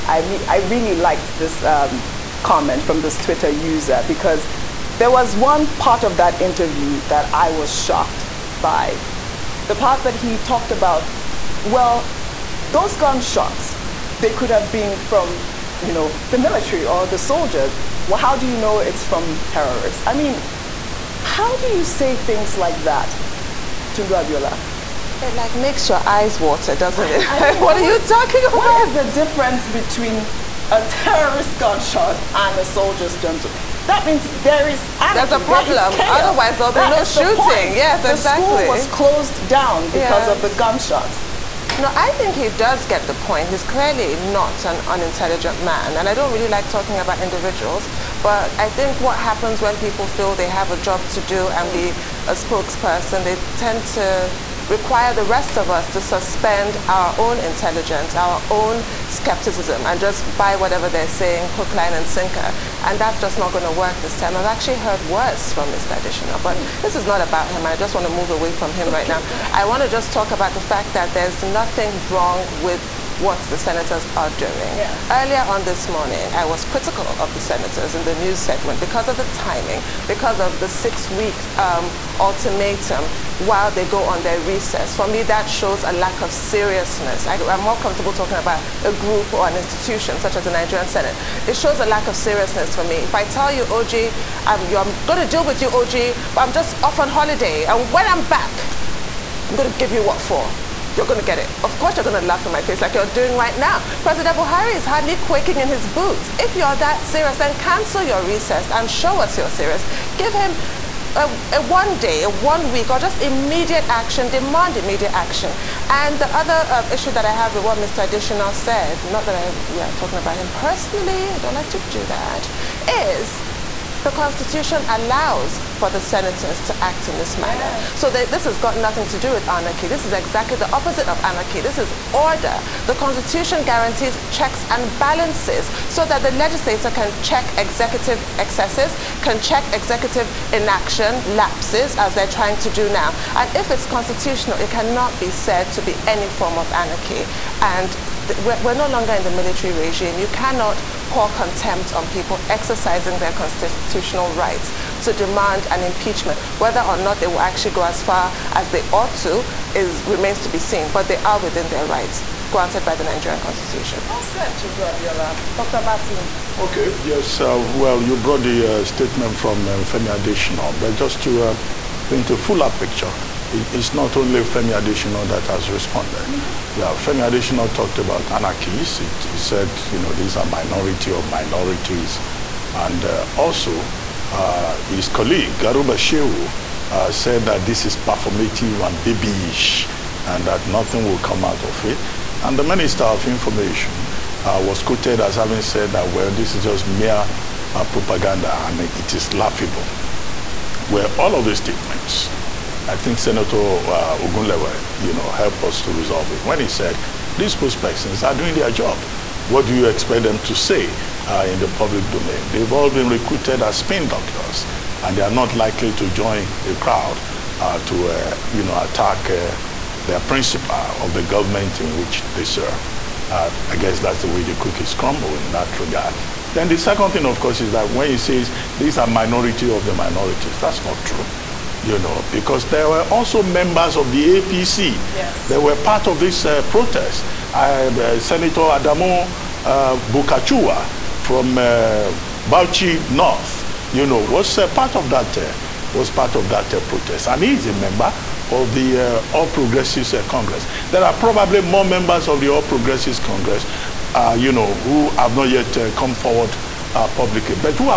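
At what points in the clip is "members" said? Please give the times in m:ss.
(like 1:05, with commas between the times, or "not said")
3:53, 4:07, 4:11.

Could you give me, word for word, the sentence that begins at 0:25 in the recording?
It like makes your eyes water, doesn't it?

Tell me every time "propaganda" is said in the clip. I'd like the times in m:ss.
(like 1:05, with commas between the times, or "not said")
3:17.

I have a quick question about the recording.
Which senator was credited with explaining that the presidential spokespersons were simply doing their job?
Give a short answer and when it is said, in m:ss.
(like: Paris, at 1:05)
Ogunlewe, at 3:24.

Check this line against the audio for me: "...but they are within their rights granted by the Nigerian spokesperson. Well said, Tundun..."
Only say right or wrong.
wrong.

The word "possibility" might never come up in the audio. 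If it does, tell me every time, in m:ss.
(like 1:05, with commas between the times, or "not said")
not said.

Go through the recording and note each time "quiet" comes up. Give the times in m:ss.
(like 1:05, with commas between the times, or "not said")
not said.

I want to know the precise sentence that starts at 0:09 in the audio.
The part that he talked about, well, those gunshots, they could have been from, you know, the military or the soldiers.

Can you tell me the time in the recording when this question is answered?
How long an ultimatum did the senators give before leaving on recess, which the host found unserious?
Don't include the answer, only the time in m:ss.
1:20.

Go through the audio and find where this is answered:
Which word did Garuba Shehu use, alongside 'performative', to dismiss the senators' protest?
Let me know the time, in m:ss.
3:09.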